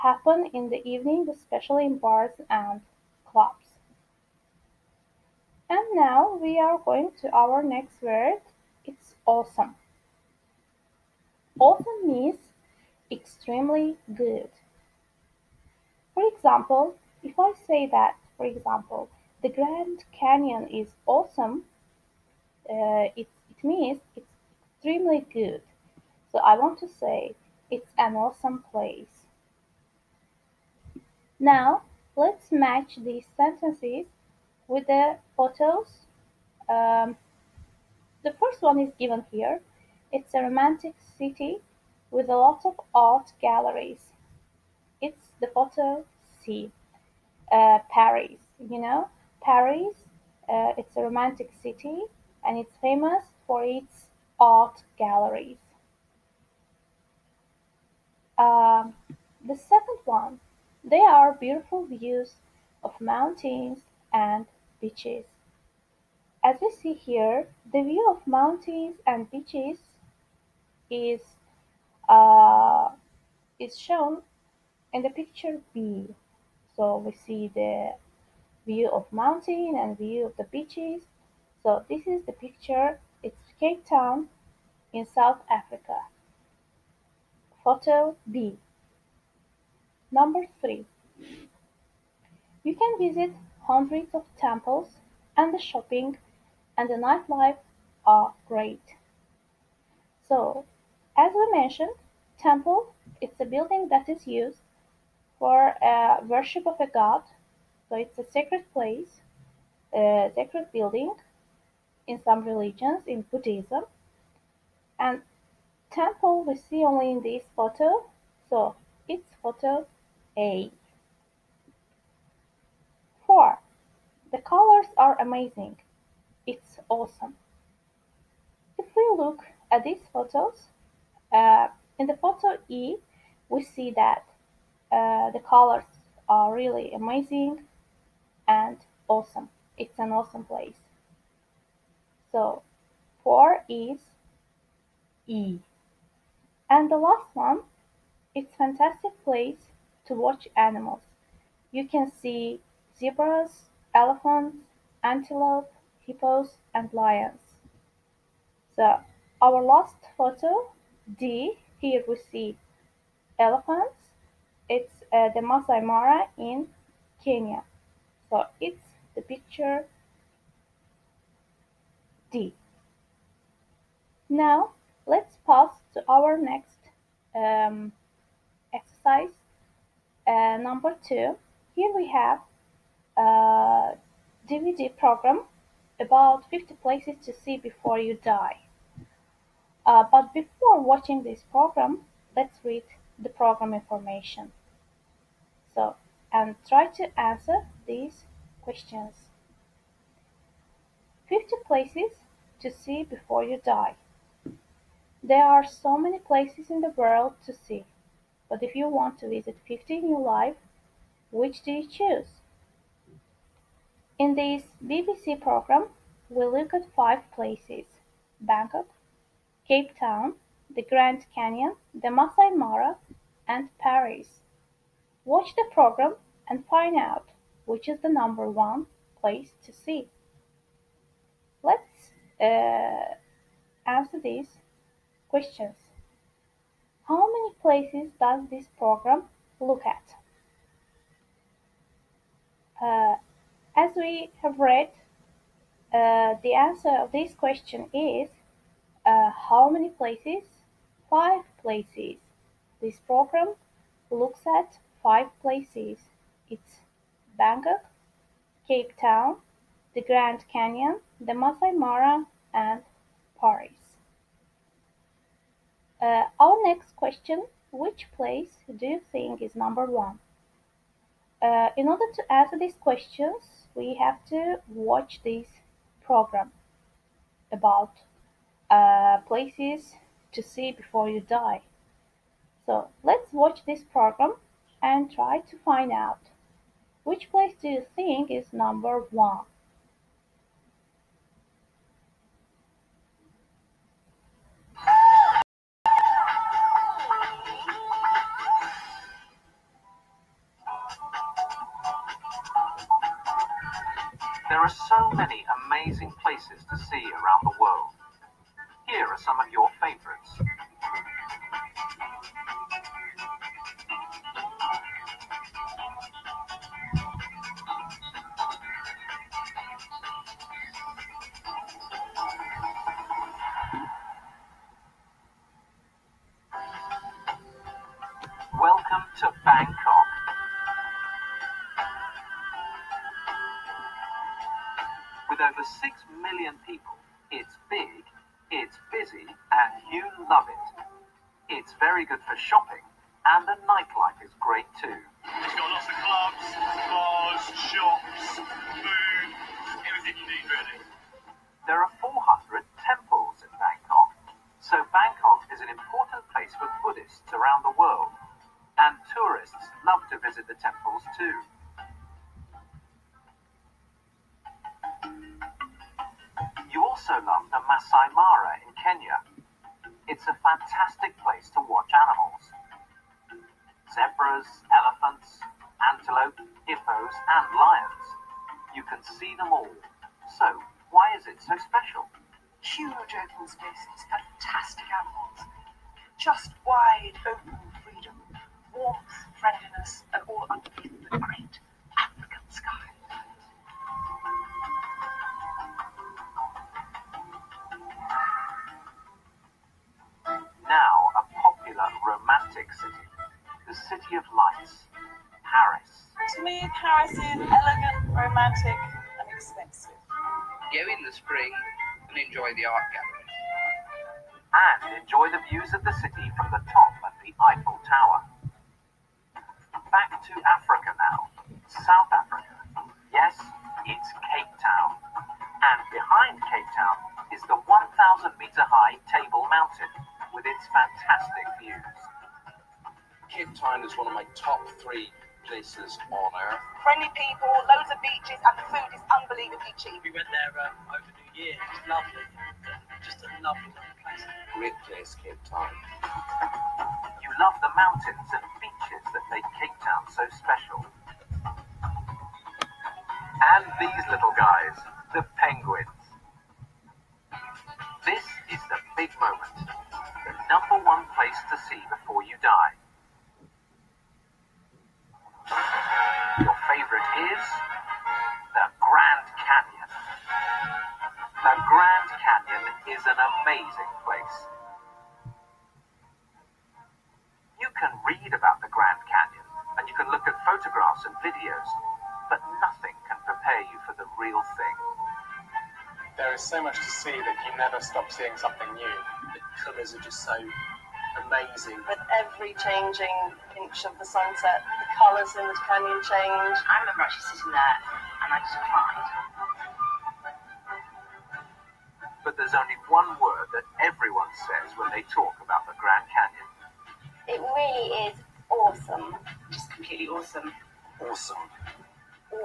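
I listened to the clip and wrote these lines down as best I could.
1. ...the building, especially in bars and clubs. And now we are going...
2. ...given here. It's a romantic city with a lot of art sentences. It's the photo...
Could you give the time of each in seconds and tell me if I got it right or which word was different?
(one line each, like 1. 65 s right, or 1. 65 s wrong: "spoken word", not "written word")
1. 0 s wrong: "evening", not "building"
2. 38 s wrong: "galleries", not "sentences".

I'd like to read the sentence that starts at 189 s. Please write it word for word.
Uh, but before watching this program, let's read the program information.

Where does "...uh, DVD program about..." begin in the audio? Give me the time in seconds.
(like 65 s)
183 s.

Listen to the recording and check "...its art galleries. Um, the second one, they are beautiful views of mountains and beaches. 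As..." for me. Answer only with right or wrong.
right.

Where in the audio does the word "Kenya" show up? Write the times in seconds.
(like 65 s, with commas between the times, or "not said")
167 s, 368 s.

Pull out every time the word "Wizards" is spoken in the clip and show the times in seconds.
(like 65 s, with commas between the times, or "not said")
not said.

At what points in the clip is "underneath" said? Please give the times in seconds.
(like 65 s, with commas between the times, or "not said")
390 s.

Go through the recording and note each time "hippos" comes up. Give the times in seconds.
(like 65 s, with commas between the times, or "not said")
156 s, 376 s.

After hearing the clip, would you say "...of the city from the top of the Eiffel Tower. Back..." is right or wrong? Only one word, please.
right.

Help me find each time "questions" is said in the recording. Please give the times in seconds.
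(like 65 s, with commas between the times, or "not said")
198 s, 235 s, 247 s, 266 s, 272 s.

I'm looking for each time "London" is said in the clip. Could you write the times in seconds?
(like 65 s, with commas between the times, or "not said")
not said.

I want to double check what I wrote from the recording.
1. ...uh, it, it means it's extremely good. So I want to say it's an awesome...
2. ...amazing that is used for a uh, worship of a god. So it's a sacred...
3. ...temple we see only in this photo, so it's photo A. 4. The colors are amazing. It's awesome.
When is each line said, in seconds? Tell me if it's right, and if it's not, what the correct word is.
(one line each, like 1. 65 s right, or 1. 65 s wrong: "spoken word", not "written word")
1. 22 s right
2. 103 s wrong: "building", not "amazing"
3. 115 s right.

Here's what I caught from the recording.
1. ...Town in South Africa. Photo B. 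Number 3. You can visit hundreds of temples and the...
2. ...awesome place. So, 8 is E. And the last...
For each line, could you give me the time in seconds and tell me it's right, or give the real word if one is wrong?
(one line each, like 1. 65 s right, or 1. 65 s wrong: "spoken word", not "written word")
1. 83 s right
2. 140 s wrong: "4", not "8".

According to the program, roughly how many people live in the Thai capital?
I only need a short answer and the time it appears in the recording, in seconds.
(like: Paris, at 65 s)
Over 6 million, at 335 s.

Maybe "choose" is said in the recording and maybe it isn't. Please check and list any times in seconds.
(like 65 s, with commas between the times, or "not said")
211 s.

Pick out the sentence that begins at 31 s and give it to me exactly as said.
Now, let's match these sentences with the photos.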